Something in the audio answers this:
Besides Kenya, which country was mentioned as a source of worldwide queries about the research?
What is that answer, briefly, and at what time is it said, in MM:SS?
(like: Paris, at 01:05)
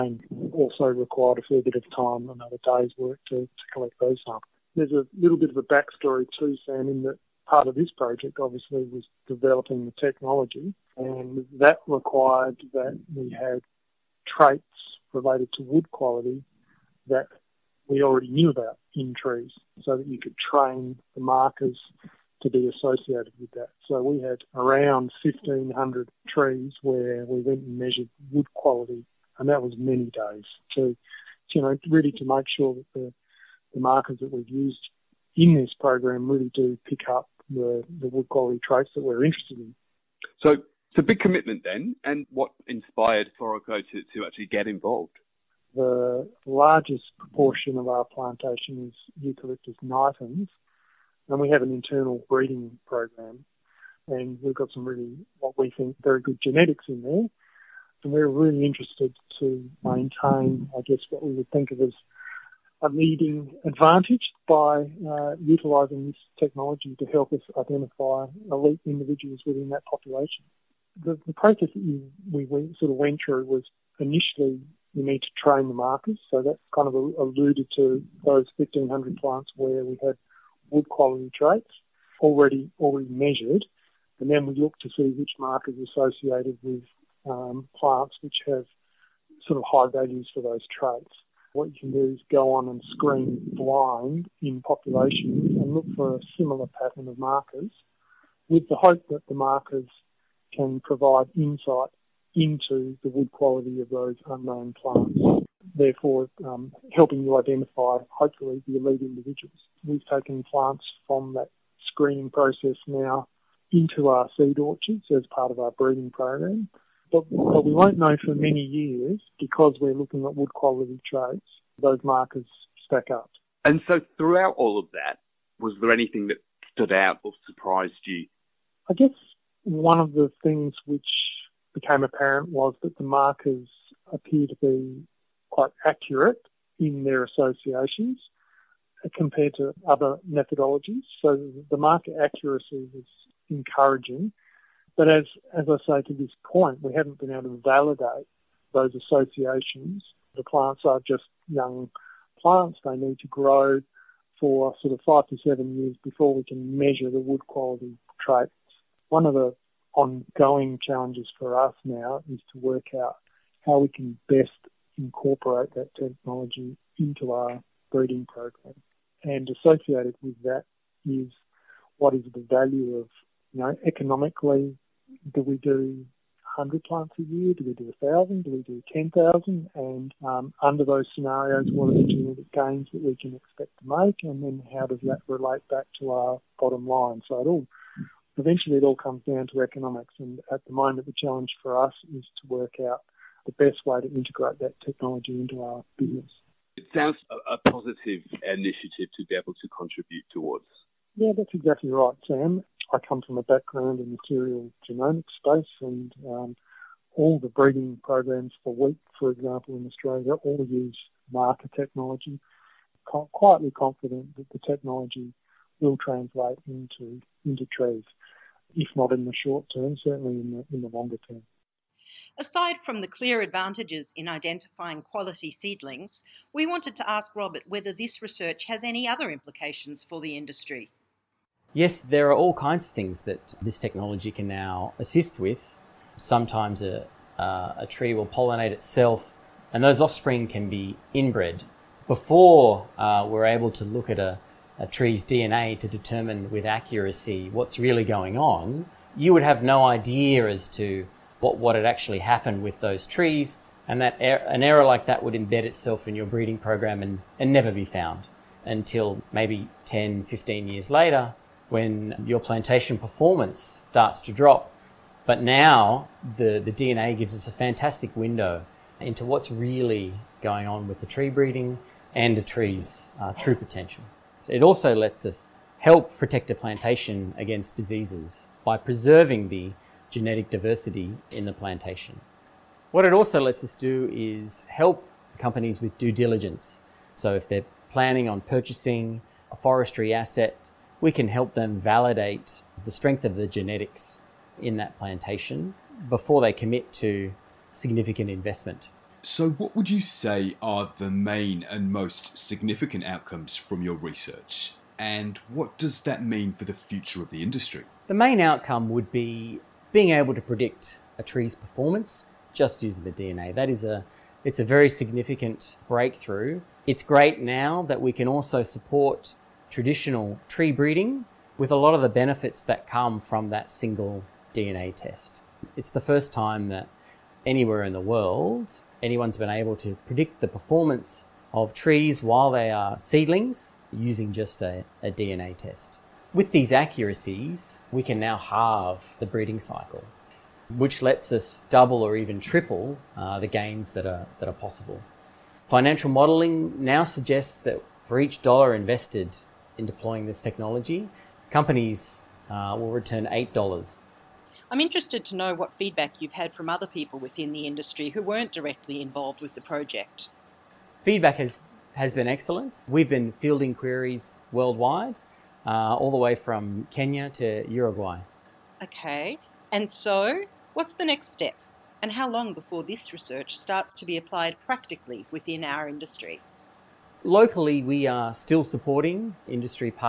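Uruguay, at 06:07.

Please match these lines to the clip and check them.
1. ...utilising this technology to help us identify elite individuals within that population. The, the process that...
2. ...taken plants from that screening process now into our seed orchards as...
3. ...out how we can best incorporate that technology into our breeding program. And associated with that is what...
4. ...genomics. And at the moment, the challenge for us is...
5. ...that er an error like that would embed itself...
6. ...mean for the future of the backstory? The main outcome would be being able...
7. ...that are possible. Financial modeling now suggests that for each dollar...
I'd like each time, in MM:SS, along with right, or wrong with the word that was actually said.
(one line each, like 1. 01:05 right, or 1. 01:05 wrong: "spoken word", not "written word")
1. 01:05 right
2. 01:50 right
3. 02:42 right
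4. 03:09 wrong: "economics", not "genomics"
5. 04:14 right
6. 05:06 wrong: "industry", not "backstory"
7. 05:44 right.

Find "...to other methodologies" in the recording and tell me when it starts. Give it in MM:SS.
02:19.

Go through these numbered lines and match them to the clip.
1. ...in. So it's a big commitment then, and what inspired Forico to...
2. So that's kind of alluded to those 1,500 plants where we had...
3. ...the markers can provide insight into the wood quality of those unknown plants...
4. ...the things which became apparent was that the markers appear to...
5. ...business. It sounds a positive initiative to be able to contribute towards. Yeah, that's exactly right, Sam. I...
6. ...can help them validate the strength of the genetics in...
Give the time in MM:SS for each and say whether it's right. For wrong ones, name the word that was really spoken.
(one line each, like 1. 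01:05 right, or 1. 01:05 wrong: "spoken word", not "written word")
1. 00:39 right
2. 01:16 right
3. 01:39 right
4. 02:10 right
5. 03:15 right
6. 04:51 right.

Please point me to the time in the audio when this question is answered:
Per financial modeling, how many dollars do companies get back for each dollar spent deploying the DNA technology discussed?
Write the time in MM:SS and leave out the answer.
05:53.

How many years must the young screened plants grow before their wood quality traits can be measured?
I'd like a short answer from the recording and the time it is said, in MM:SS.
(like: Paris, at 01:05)
5 to 7 years, at 02:35.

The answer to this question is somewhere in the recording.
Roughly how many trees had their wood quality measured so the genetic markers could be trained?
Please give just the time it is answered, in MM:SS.
00:25.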